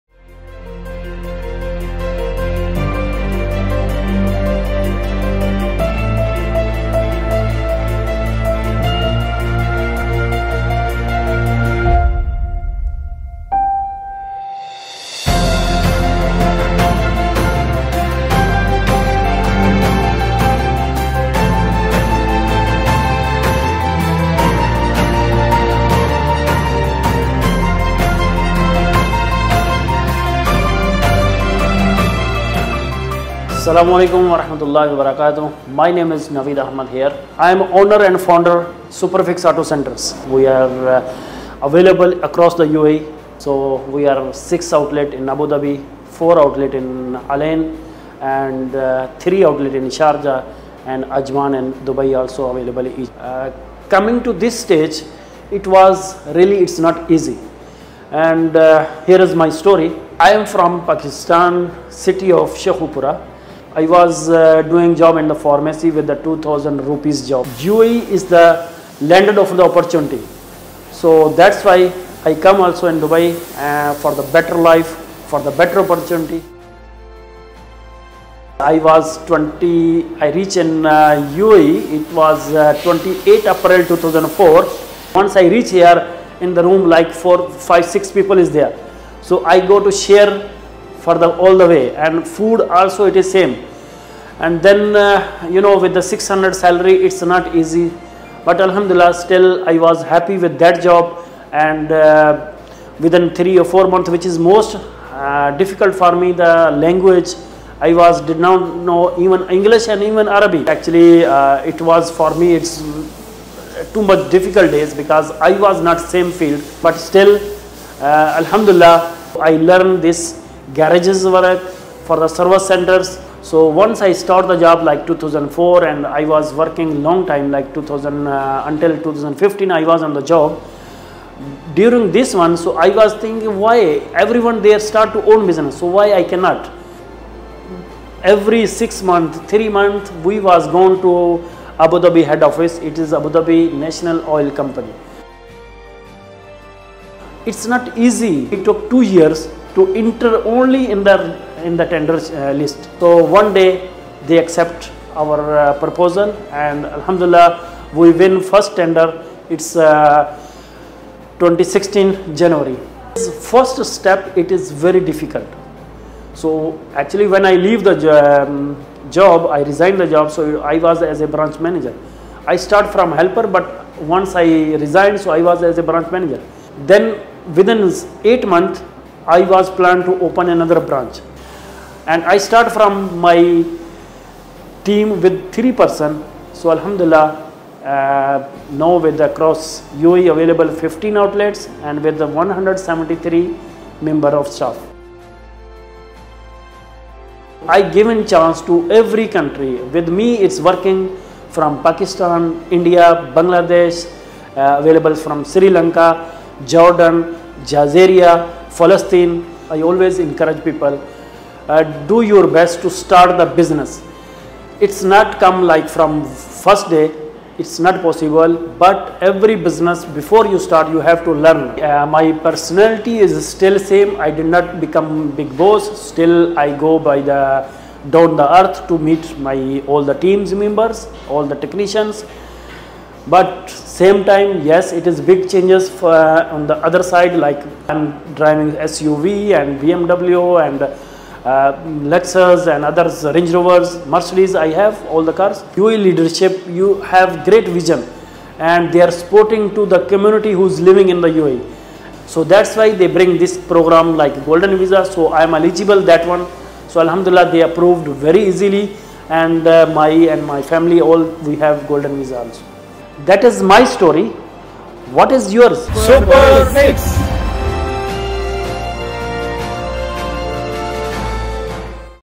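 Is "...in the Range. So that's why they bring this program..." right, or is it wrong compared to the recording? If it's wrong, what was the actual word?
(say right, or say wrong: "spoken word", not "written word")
wrong: "UAE", not "Range".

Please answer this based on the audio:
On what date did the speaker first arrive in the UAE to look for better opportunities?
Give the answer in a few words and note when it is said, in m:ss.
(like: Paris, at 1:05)
28 April 2004, at 1:22.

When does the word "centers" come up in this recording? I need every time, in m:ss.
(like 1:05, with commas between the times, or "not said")
0:39, 2:02.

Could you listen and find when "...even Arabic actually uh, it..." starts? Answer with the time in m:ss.
1:50.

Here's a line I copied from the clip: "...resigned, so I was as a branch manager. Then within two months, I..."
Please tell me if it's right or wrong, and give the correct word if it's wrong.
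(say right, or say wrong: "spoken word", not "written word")
wrong: "eight", not "two".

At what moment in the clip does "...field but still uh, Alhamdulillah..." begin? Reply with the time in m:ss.
1:56.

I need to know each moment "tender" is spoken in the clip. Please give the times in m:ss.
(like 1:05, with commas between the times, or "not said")
2:31, 2:38.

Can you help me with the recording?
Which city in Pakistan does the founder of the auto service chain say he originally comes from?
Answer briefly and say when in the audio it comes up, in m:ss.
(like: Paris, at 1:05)
Sheikhupura, at 1:02.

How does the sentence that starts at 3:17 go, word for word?
I given chance to every country.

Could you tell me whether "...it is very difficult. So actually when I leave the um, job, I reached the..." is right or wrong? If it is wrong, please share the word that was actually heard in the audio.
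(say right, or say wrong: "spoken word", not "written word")
wrong: "resigned", not "reached".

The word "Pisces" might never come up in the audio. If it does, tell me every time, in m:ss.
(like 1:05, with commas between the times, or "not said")
not said.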